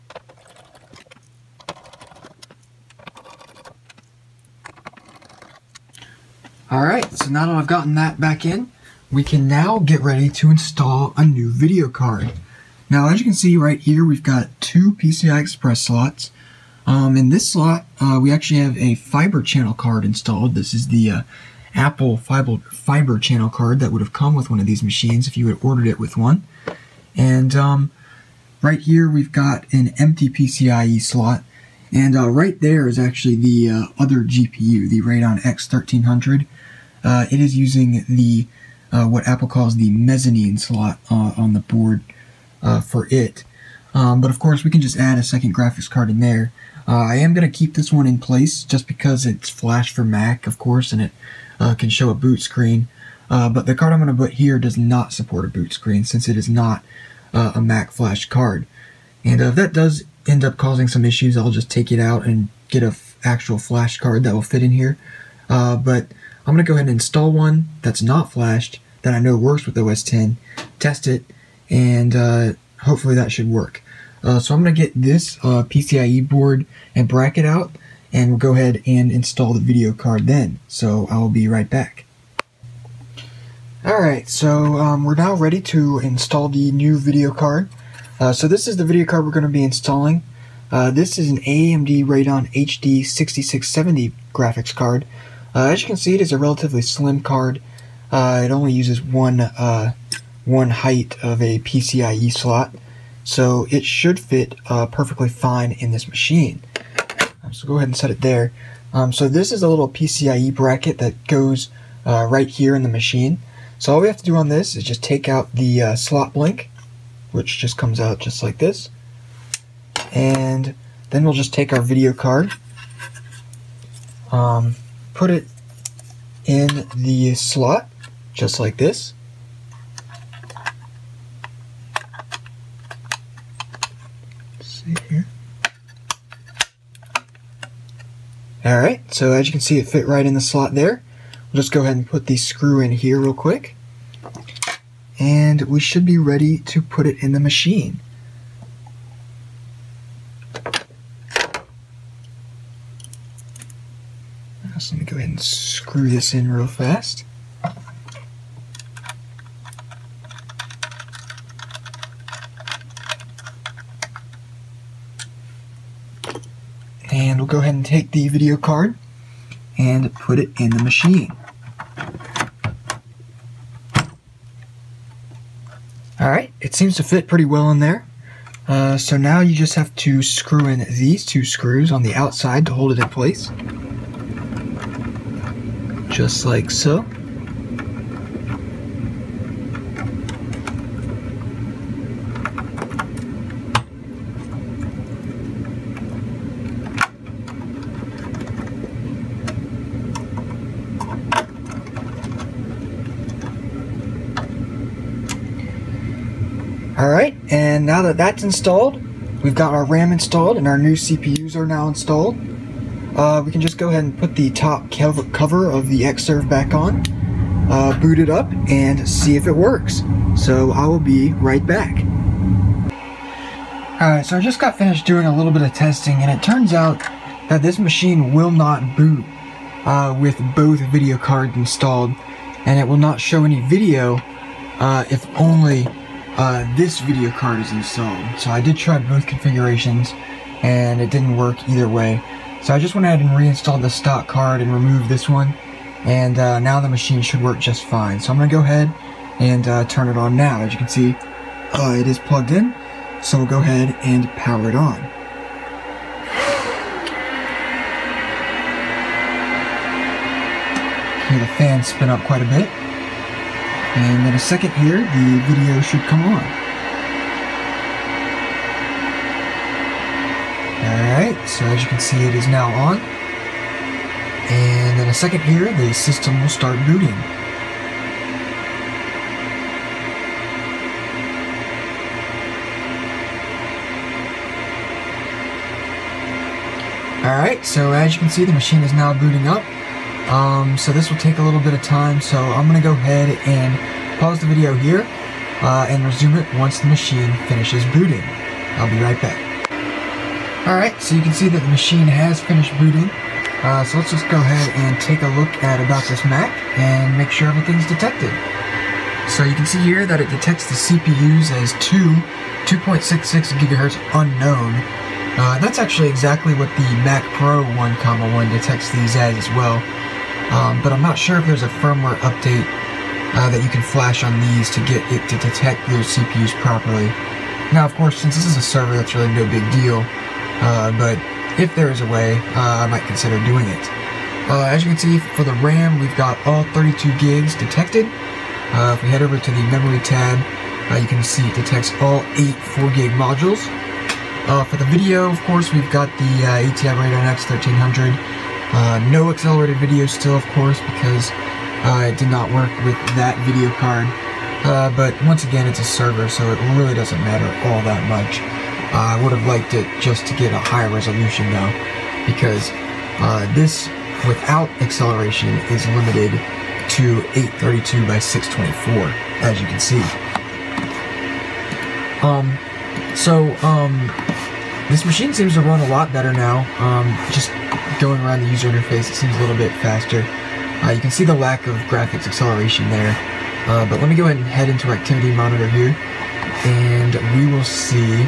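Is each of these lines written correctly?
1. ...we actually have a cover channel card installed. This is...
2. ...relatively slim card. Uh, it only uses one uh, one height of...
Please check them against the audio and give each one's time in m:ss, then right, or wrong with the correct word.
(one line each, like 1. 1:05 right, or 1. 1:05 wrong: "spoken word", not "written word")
1. 0:18 wrong: "fiber", not "cover"
2. 1:36 right.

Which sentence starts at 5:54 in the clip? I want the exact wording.
Uh, but once again, it's a server, so it really doesn't matter all that much.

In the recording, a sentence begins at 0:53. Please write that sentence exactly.
but the card I'm going to put here does not support a boot screen since it is not a Mac flash card.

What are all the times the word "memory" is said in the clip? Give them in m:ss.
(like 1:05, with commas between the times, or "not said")
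5:39.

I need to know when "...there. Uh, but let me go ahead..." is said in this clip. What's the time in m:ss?
6:22.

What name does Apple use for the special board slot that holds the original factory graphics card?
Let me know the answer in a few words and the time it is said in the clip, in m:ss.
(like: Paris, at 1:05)
Mezzanine slot, at 0:39.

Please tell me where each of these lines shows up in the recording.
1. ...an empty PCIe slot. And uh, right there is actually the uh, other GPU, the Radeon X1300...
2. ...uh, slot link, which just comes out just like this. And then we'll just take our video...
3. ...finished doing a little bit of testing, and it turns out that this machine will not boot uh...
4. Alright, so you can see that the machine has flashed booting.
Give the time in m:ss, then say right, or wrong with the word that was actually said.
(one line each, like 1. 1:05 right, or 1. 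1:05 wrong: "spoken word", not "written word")
1. 0:29 right
2. 1:55 right
3. 3:44 right
4. 5:00 wrong: "finished", not "flashed".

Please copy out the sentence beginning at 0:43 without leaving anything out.
Um, but of course, we can just add a second graphics card in there.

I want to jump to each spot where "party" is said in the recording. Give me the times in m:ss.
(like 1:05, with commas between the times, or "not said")
not said.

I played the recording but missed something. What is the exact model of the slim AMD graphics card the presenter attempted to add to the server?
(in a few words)
Radeon HD 6670.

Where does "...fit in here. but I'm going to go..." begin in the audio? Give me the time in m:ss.
1:04.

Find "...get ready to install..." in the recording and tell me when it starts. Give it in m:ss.
0:09.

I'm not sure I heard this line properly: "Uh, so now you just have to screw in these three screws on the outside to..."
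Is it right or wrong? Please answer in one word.
wrong.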